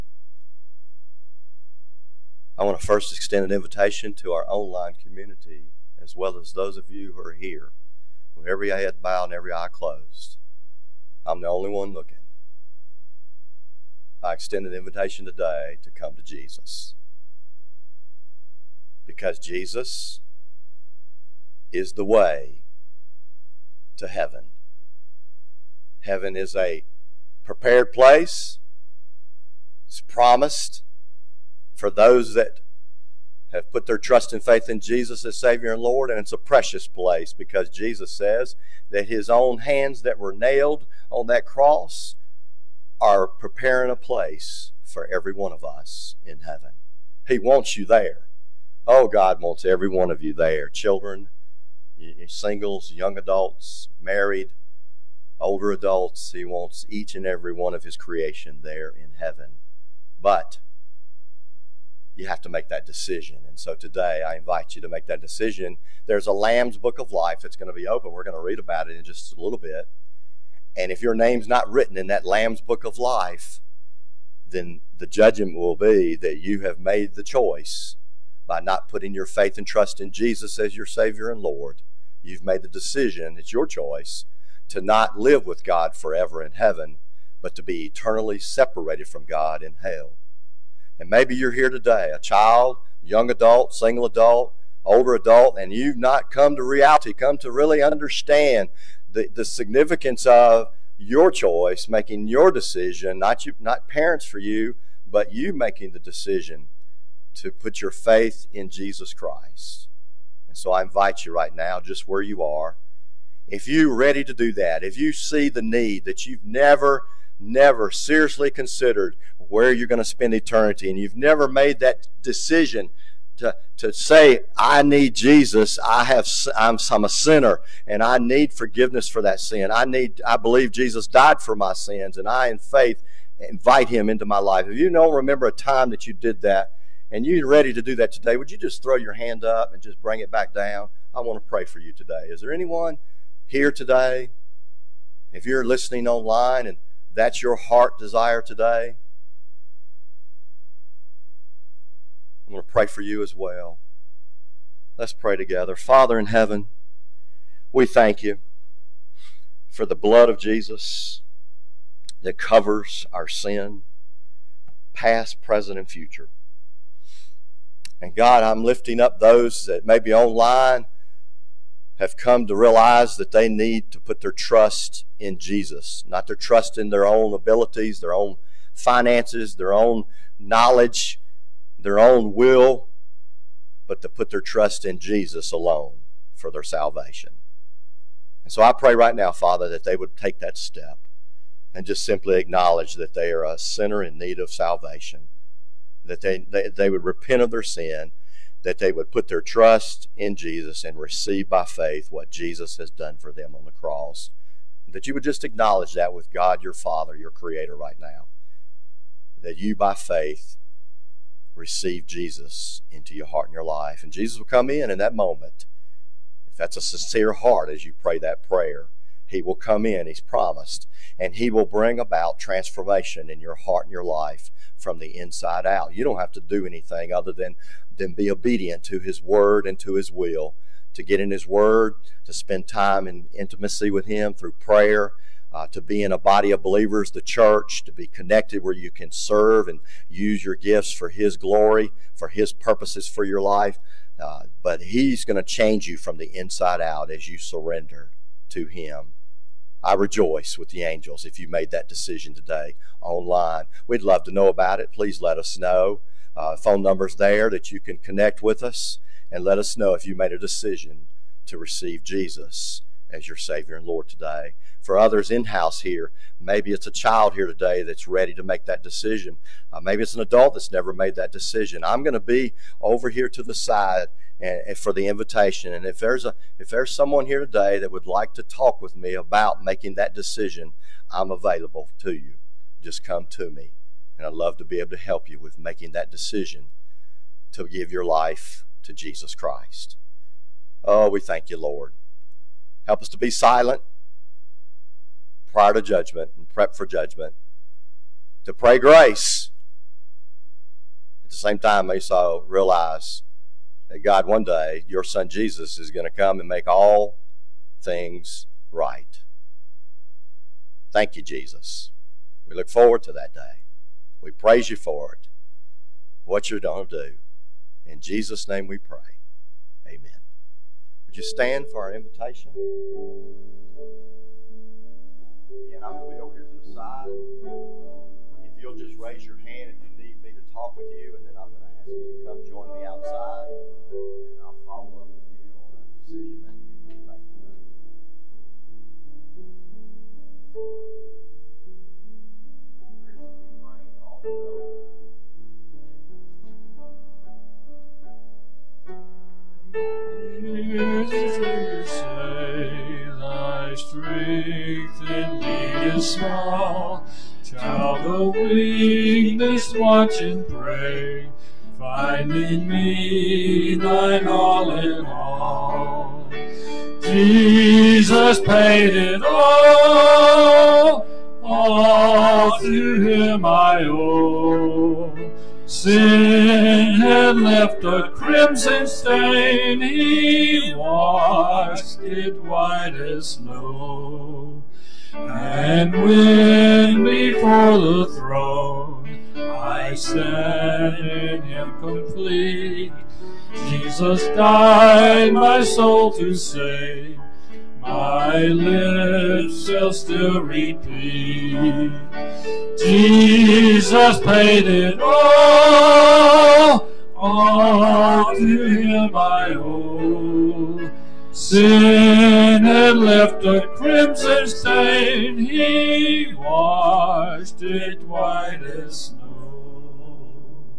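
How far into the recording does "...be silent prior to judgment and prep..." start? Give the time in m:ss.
4:53.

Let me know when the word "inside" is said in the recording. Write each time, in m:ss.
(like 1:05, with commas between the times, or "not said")
3:45, 4:06.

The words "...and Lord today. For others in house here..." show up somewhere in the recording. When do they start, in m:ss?
4:23.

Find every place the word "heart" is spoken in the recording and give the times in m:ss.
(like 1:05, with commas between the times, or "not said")
2:27, 3:33, 3:37, 3:43.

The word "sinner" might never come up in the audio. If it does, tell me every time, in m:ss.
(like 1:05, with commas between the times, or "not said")
2:07, 3:13.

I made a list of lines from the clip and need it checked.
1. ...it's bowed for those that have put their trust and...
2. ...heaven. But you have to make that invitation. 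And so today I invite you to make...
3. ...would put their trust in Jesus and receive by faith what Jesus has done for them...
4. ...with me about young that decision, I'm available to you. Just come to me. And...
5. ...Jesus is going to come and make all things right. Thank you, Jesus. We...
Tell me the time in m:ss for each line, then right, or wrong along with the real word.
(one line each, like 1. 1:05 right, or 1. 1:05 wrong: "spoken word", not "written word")
1. 0:29 wrong: "promised", not "bowed"
2. 0:59 wrong: "decision", not "invitation"
3. 3:18 right
4. 4:38 wrong: "making", not "young"
5. 5:05 right.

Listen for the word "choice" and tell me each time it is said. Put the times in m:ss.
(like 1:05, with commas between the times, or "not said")
1:17, 1:23, 1:41.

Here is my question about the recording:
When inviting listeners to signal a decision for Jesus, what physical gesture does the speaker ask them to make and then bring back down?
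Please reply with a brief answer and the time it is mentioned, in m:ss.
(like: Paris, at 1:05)
throw your hand up, at 2:18.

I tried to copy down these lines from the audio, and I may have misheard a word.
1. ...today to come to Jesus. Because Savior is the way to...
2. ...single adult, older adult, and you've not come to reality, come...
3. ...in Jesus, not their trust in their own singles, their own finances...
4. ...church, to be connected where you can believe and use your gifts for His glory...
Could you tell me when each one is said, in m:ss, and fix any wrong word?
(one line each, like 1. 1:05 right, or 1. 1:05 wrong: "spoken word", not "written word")
1. 0:15 wrong: "Jesus", not "Savior"
2. 1:33 right
3. 2:55 wrong: "abilities", not "singles"
4. 3:57 wrong: "serve", not "believe".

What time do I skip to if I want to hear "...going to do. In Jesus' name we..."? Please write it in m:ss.
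5:16.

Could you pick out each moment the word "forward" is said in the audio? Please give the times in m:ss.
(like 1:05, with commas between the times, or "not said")
5:12.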